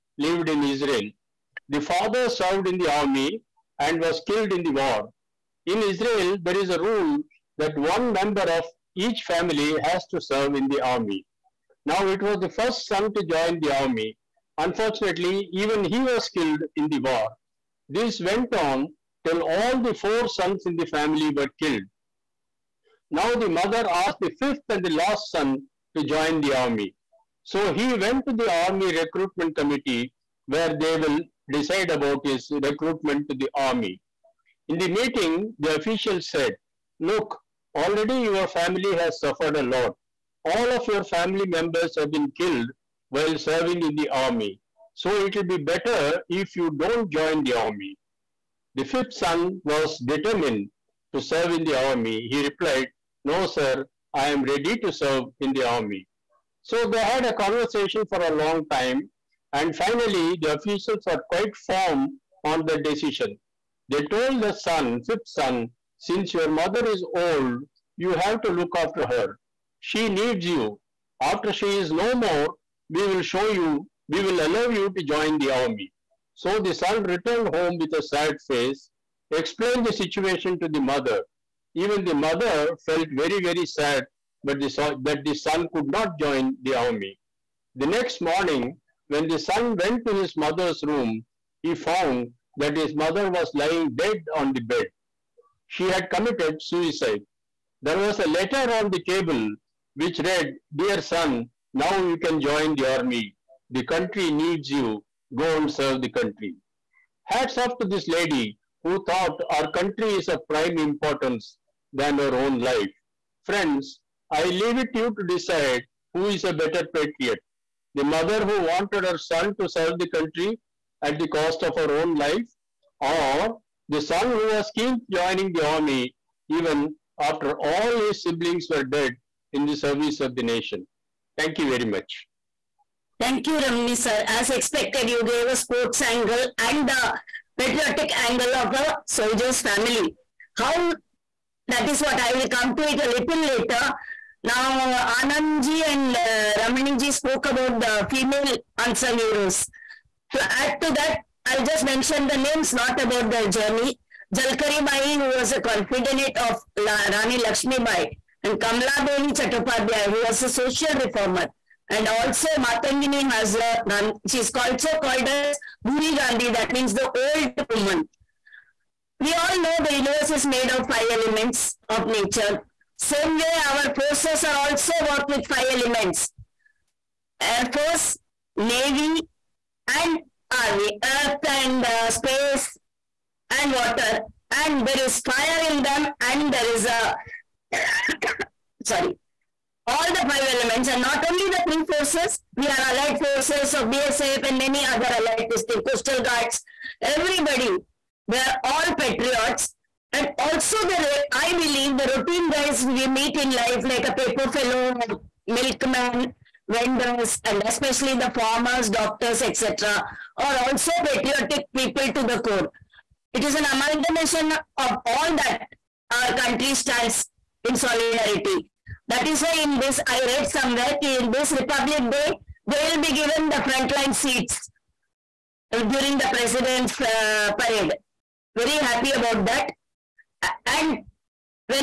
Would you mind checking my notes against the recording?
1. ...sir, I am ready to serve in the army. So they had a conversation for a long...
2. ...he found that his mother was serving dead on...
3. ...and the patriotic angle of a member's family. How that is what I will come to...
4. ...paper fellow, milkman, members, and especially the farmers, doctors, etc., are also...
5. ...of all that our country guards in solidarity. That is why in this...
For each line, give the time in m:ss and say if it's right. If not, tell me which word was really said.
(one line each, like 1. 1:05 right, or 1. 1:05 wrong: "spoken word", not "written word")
1. 0:53 right
2. 1:31 wrong: "lying", not "serving"
3. 2:16 wrong: "soldier", not "member"
4. 3:24 wrong: "vendors", not "members"
5. 3:34 wrong: "stands", not "guards".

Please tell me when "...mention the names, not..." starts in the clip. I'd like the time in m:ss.
2:31.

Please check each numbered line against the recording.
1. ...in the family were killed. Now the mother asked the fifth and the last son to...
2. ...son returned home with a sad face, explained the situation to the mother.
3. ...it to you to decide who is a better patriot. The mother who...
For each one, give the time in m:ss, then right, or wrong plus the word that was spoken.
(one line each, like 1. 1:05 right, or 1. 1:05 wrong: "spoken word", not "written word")
1. 0:20 right
2. 1:16 right
3. 1:54 right.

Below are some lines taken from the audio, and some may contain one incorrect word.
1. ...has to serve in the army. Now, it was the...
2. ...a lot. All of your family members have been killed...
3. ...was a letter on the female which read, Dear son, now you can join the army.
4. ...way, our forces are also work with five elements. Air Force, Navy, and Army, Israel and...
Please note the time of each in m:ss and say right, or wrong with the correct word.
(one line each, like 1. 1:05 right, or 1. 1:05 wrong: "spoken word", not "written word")
1. 0:09 right
2. 0:39 right
3. 1:37 wrong: "table", not "female"
4. 2:53 wrong: "Earth", not "Israel".